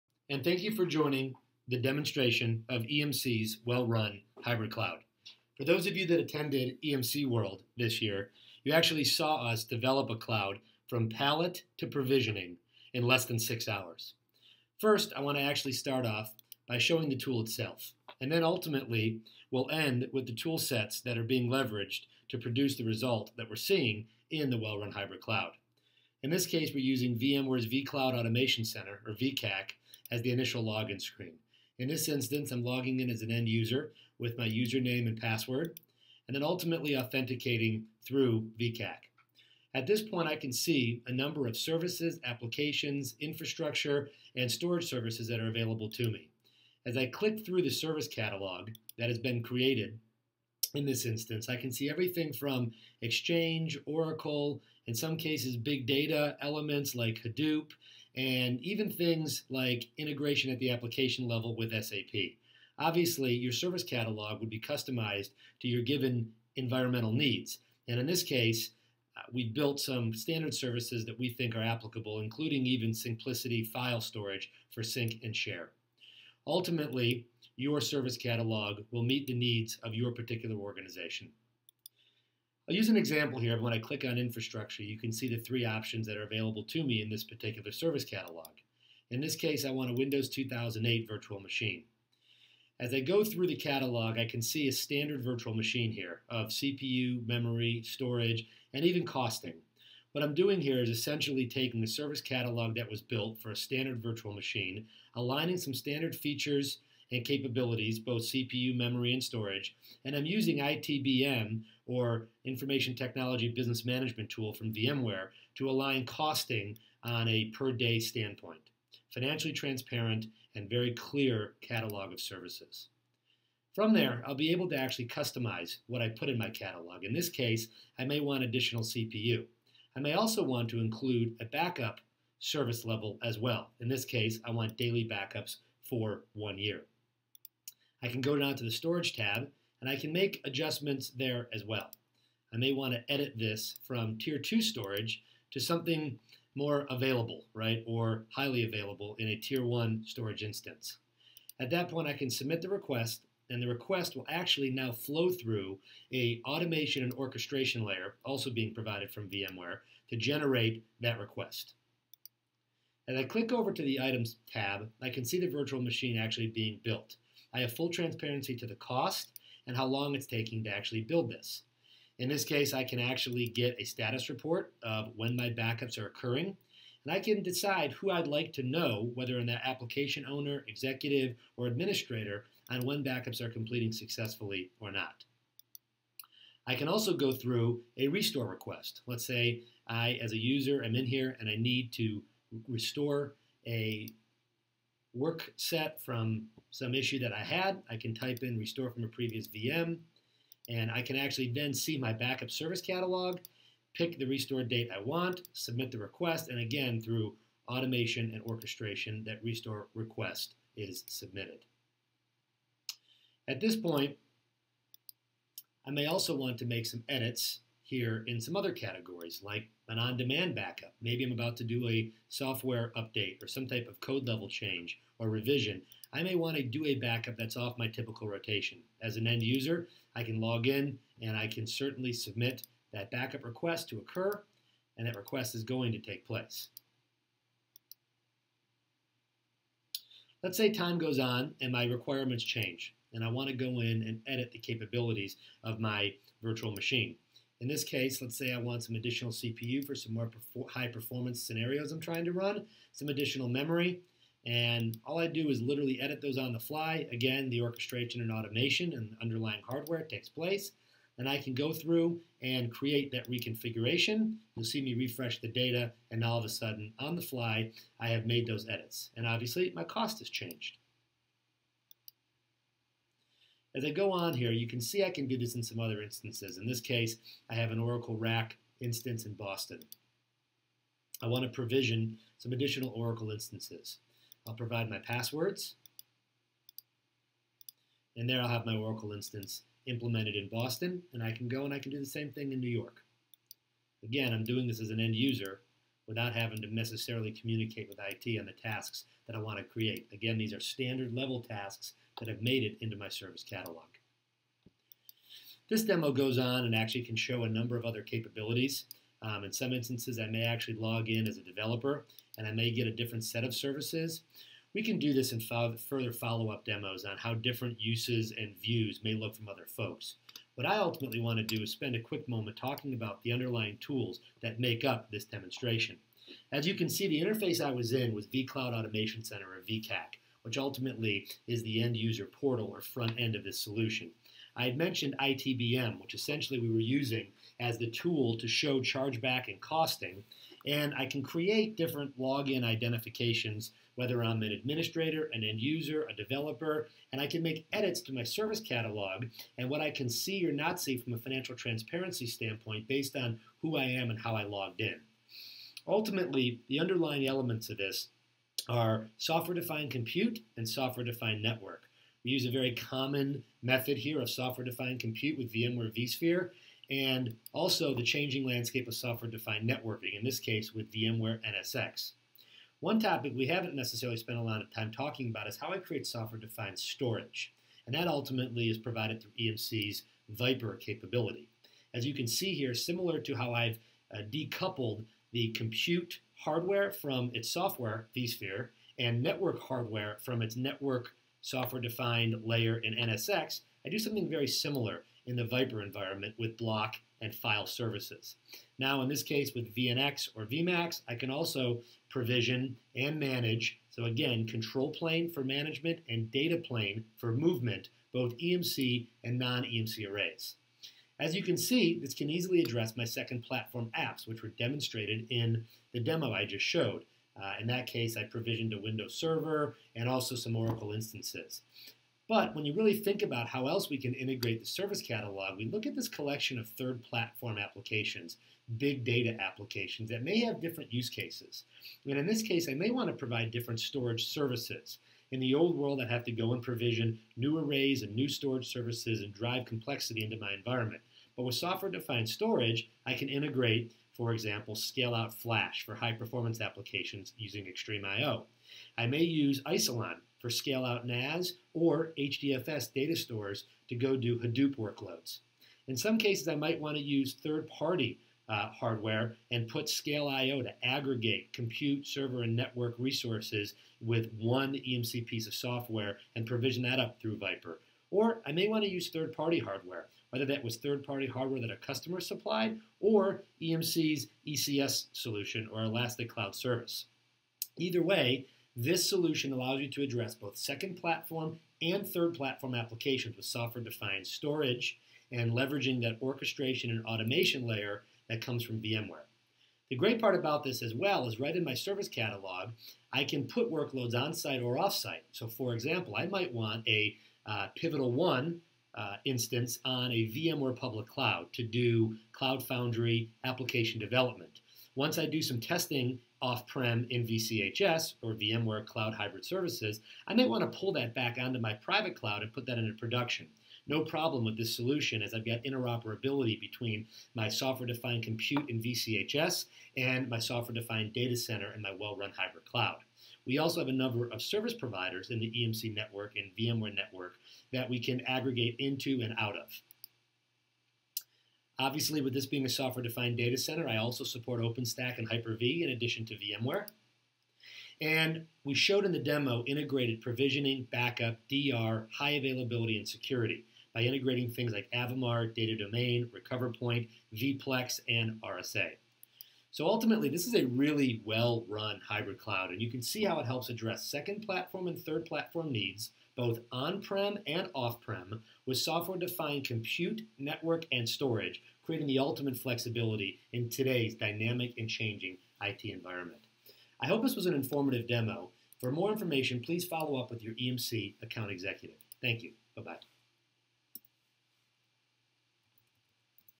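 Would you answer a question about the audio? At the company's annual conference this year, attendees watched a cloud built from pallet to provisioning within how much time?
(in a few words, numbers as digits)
less than six hours.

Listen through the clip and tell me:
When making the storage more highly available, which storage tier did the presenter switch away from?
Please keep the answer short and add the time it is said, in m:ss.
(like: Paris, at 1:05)
tier 2, at 2:24.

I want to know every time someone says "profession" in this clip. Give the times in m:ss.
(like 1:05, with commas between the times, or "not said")
not said.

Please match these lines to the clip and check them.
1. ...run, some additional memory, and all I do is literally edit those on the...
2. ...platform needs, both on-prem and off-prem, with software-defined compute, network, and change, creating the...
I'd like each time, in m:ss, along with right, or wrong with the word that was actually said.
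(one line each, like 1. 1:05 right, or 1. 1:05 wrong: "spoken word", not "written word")
1. 4:12 right
2. 9:15 wrong: "storage", not "change".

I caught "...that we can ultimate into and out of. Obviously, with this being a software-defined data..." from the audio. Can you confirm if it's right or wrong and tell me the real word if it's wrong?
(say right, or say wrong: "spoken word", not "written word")
wrong: "aggregate", not "ultimate".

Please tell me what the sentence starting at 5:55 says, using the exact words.
Ultimately, the underlying elements of this are software-defined compute and software-defined network.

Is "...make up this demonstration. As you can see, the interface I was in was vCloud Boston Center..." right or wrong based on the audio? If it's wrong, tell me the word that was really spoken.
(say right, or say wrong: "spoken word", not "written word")
wrong: "Automation", not "Boston".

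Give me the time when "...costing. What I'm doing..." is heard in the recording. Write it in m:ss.
1:39.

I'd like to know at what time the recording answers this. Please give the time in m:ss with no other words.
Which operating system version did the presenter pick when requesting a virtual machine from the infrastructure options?
1:29.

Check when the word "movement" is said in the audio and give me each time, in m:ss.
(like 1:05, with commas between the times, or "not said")
6:47.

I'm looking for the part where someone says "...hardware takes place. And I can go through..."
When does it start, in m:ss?
4:19.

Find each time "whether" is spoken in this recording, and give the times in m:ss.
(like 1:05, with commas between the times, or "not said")
2:59, 5:43, 7:50.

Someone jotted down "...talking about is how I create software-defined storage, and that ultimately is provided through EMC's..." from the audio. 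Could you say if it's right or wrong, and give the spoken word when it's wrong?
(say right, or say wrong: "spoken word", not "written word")
right.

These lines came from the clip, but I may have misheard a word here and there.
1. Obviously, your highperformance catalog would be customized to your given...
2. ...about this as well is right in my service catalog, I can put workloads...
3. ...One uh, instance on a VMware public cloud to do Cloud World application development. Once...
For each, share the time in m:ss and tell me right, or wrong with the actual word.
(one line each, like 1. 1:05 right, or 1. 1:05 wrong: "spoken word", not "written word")
1. 1:02 wrong: "service", not "highperformance"
2. 8:10 right
3. 8:18 wrong: "Foundry", not "World".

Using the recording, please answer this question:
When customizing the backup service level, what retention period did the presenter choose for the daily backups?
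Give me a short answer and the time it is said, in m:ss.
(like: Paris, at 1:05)
one year, at 2:16.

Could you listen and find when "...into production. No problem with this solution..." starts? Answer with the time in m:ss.
8:32.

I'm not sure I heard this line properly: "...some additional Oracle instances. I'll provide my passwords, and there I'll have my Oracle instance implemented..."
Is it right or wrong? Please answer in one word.
right.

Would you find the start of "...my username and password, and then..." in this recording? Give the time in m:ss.
0:34.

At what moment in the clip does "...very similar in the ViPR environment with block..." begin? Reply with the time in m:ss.
6:34.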